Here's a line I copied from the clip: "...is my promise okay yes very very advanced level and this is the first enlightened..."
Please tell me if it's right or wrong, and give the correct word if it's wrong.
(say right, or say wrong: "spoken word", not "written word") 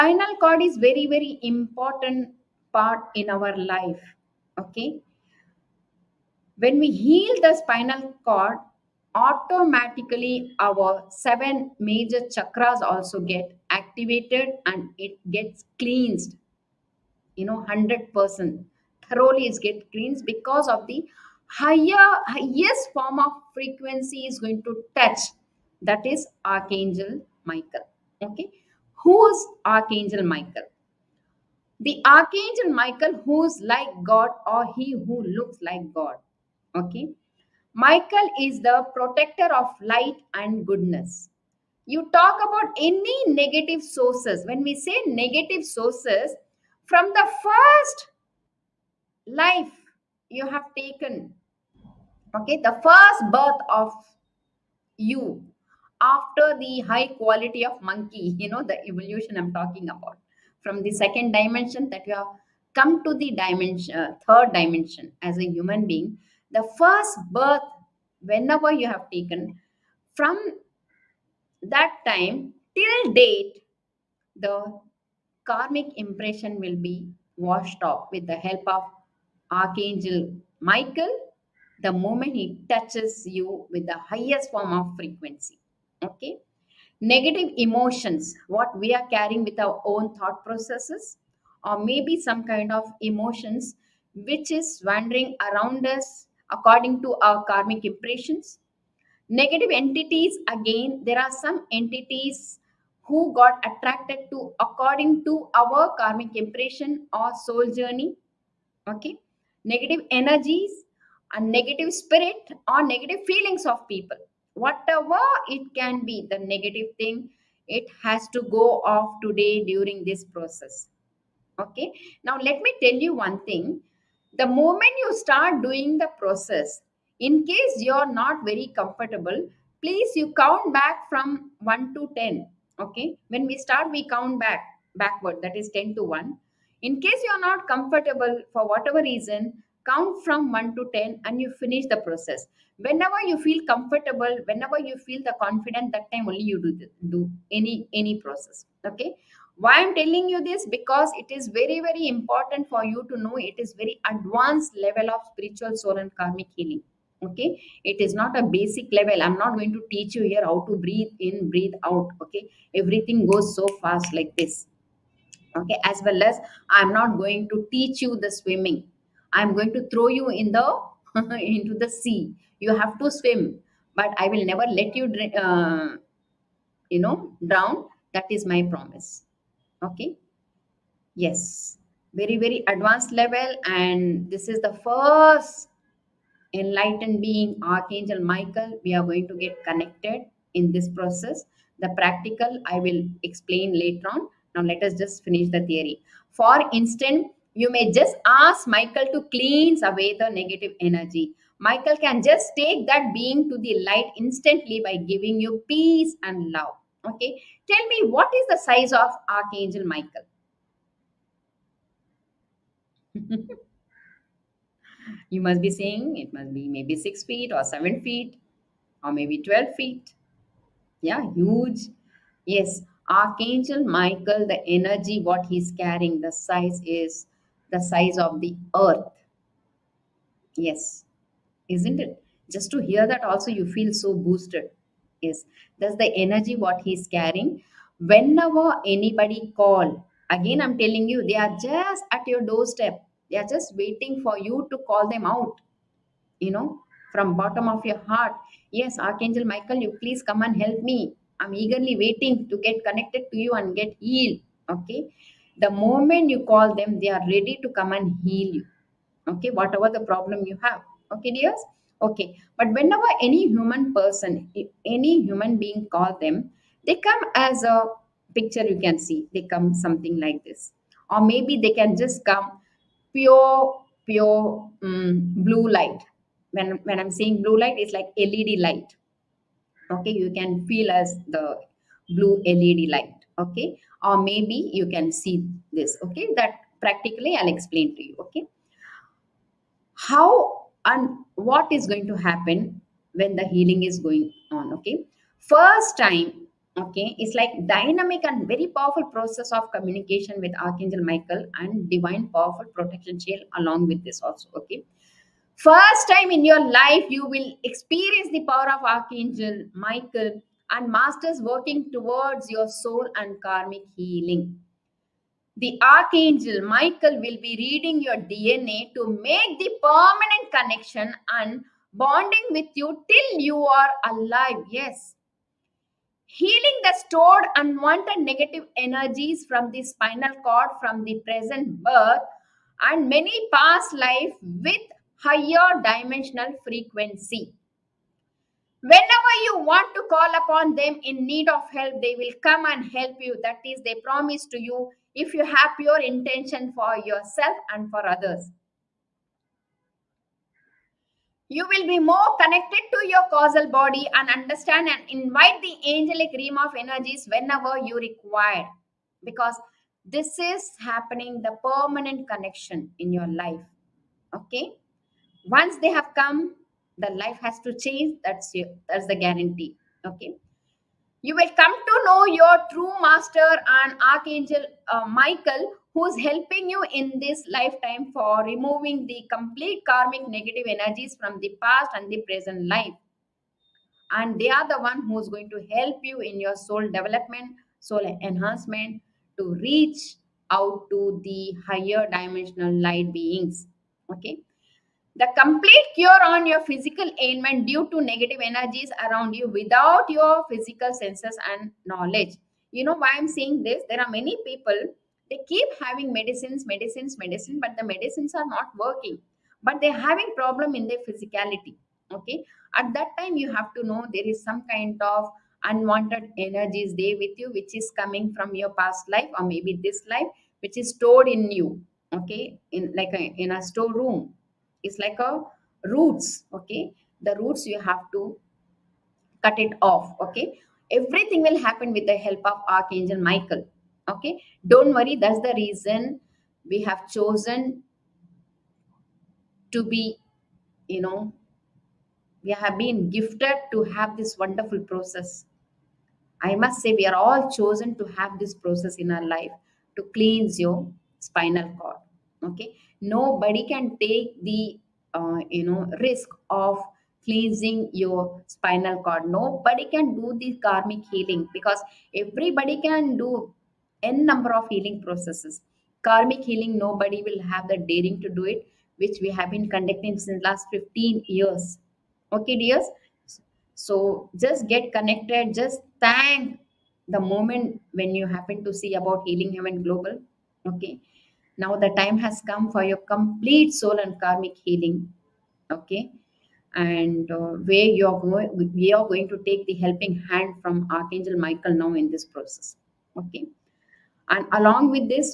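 right.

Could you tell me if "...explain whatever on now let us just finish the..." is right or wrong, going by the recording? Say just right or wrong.
wrong.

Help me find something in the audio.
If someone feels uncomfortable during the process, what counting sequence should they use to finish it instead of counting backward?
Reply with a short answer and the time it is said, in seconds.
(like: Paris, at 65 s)
1 to 10, at 139 s.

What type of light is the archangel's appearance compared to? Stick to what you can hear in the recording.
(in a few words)
Blue LED light.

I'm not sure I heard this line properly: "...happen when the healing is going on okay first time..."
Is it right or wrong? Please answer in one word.
right.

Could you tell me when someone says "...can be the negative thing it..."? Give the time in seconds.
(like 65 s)
115 s.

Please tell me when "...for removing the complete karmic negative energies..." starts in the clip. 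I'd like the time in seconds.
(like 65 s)
378 s.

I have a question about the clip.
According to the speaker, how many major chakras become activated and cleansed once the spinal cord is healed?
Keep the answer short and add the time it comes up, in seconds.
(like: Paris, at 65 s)
7, at 11 s.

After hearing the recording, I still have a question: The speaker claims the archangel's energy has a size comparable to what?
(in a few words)
The Earth.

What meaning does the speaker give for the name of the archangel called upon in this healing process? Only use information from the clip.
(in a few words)
He who looks like god.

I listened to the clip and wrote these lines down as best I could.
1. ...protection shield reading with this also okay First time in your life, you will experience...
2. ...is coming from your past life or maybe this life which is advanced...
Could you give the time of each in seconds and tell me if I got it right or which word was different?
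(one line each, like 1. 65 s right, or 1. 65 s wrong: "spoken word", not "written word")
1. 302 s wrong: "along", not "reading"
2. 417 s wrong: "stored", not "advanced".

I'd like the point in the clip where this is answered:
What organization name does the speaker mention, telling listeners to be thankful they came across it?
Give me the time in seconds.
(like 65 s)
479 s.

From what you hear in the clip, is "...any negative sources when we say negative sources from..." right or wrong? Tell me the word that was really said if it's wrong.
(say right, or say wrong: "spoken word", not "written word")
right.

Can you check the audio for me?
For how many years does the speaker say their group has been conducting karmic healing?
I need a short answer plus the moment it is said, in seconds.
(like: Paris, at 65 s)
15, at 470 s.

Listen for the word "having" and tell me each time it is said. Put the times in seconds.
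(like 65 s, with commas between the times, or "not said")
405 s, 410 s.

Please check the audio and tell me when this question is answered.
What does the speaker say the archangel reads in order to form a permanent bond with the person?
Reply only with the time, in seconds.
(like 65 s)
318 s.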